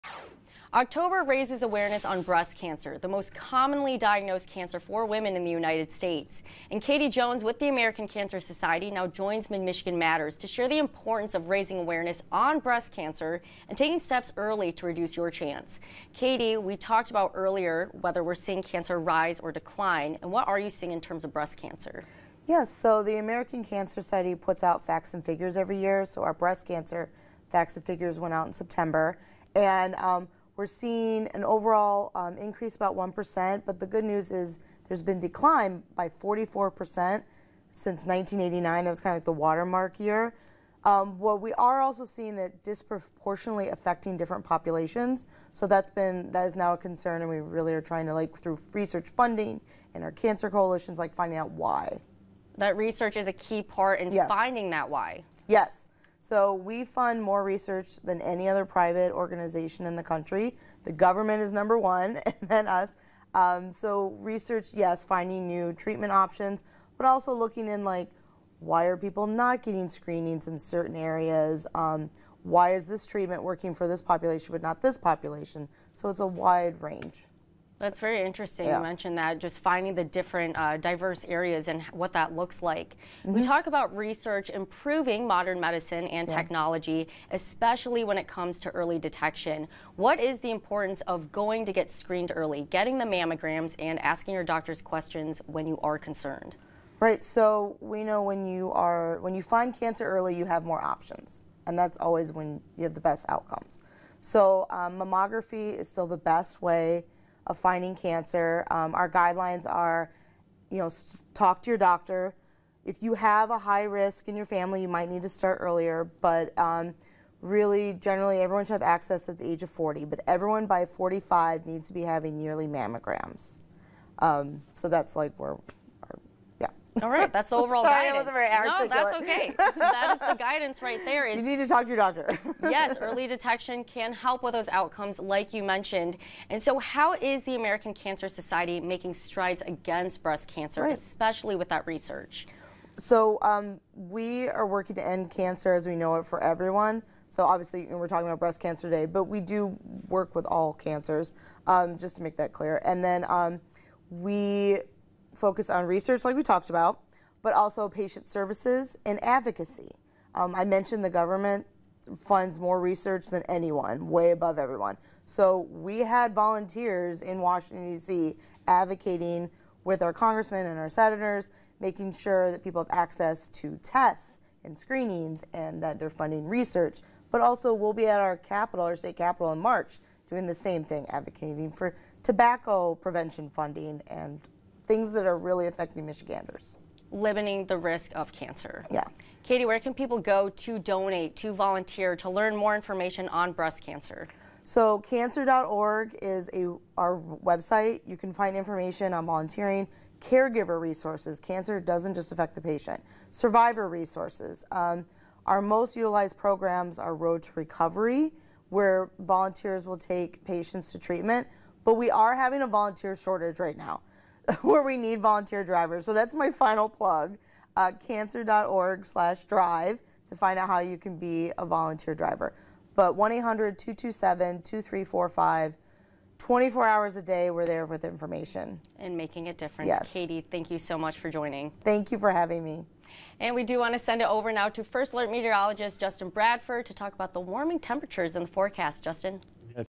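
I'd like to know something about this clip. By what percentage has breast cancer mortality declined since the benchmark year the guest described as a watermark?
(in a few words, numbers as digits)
44%.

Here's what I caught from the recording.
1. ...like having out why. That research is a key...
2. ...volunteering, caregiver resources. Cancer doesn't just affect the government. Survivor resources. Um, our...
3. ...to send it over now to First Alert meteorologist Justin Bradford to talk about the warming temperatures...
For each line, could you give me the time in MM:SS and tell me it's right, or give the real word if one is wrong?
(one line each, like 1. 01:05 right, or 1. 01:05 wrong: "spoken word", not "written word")
1. 00:50 wrong: "finding", not "having"
2. 03:19 wrong: "patient", not "government"
3. 03:53 right.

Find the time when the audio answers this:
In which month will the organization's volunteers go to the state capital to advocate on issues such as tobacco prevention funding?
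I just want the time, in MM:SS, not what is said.
02:59.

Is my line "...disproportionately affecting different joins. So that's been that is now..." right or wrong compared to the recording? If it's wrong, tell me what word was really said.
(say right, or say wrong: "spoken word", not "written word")
wrong: "populations", not "joins".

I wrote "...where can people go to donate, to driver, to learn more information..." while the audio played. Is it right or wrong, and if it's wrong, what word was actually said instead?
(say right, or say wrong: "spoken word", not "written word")
wrong: "volunteer", not "driver".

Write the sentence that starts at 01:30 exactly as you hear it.
What is the importance of going to get screened early, getting the mammograms, and asking your doctors questions when you are concerned?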